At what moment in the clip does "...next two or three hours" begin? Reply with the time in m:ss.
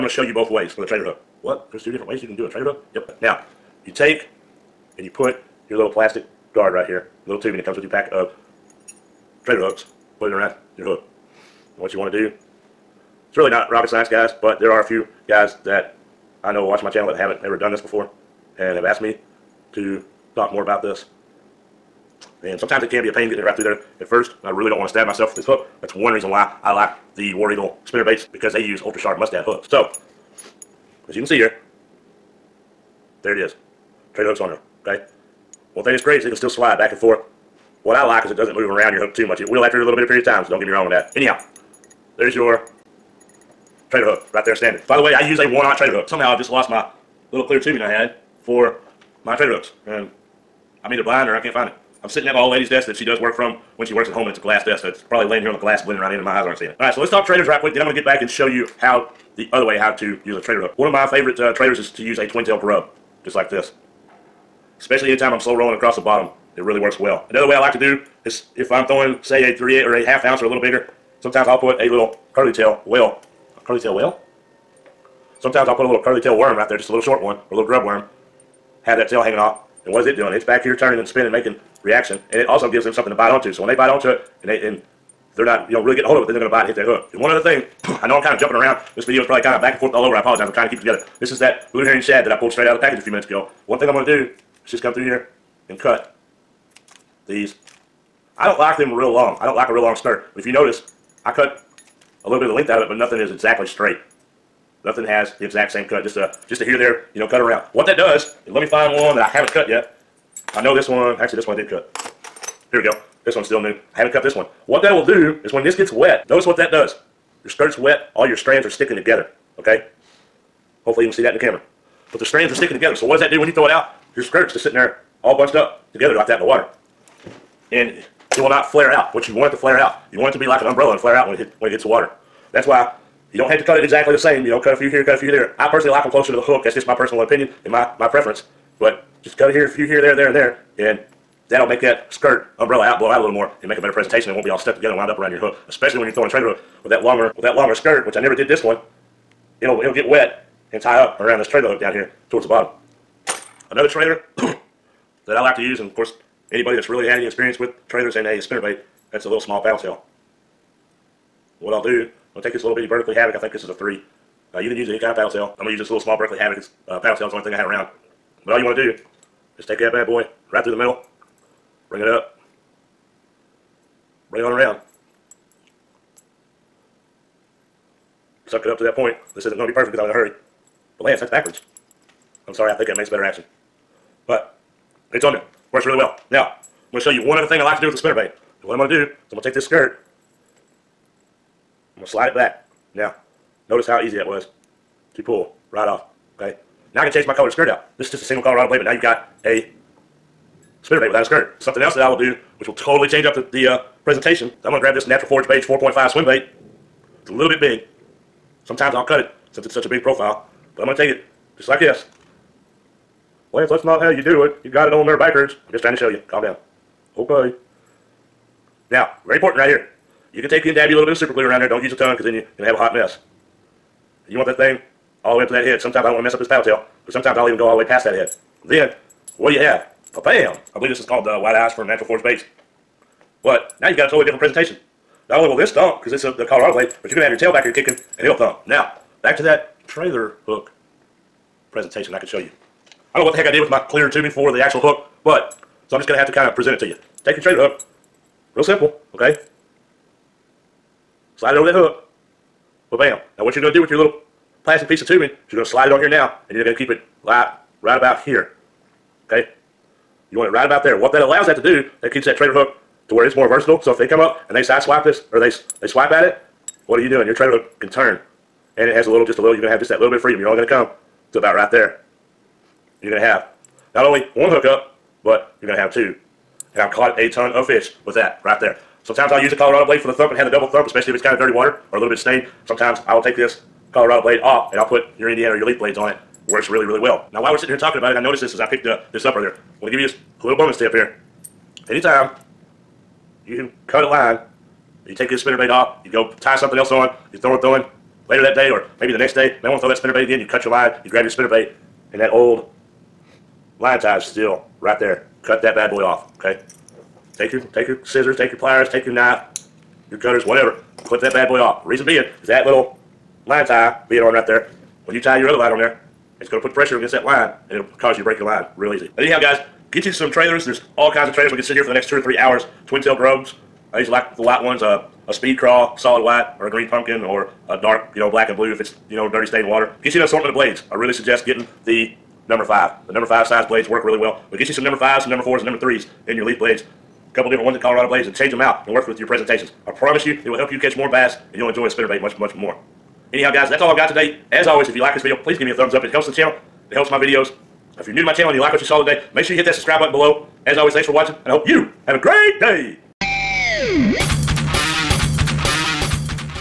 5:21.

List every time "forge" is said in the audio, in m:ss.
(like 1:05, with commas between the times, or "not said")
3:25, 3:52.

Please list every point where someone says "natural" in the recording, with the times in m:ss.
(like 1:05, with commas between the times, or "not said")
3:25, 3:51.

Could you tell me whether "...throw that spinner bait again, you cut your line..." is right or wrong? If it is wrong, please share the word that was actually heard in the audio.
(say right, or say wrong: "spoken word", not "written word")
right.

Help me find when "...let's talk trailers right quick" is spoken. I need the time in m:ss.
0:57.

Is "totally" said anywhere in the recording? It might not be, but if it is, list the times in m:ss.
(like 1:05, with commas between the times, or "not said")
3:22, 3:54.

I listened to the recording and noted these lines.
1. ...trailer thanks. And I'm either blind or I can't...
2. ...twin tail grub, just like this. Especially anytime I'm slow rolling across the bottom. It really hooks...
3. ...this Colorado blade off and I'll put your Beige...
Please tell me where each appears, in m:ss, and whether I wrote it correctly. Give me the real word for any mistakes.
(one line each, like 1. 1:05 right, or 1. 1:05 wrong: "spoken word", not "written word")
1. 0:49 wrong: "hooks", not "thanks"
2. 1:02 wrong: "works", not "hooks"
3. 4:43 wrong: "Indiana", not "Beige".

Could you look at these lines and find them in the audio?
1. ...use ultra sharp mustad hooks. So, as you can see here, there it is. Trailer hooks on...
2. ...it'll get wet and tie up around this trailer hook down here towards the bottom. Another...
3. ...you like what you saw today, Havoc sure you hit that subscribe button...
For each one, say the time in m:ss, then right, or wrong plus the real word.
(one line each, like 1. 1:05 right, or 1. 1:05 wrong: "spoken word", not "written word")
1. 0:28 right
2. 2:29 right
3. 5:48 wrong: "Make", not "Havoc".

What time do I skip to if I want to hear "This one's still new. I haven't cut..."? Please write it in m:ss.
1:53.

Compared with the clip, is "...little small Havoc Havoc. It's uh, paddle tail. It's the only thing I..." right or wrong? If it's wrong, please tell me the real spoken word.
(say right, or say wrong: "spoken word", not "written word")
wrong: "Berkley", not "Havoc".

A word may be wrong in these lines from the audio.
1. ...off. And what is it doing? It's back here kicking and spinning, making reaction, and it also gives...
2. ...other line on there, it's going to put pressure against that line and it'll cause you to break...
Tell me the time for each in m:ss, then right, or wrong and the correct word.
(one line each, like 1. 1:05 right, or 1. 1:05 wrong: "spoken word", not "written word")
1. 1:19 wrong: "turning", not "kicking"
2. 5:15 right.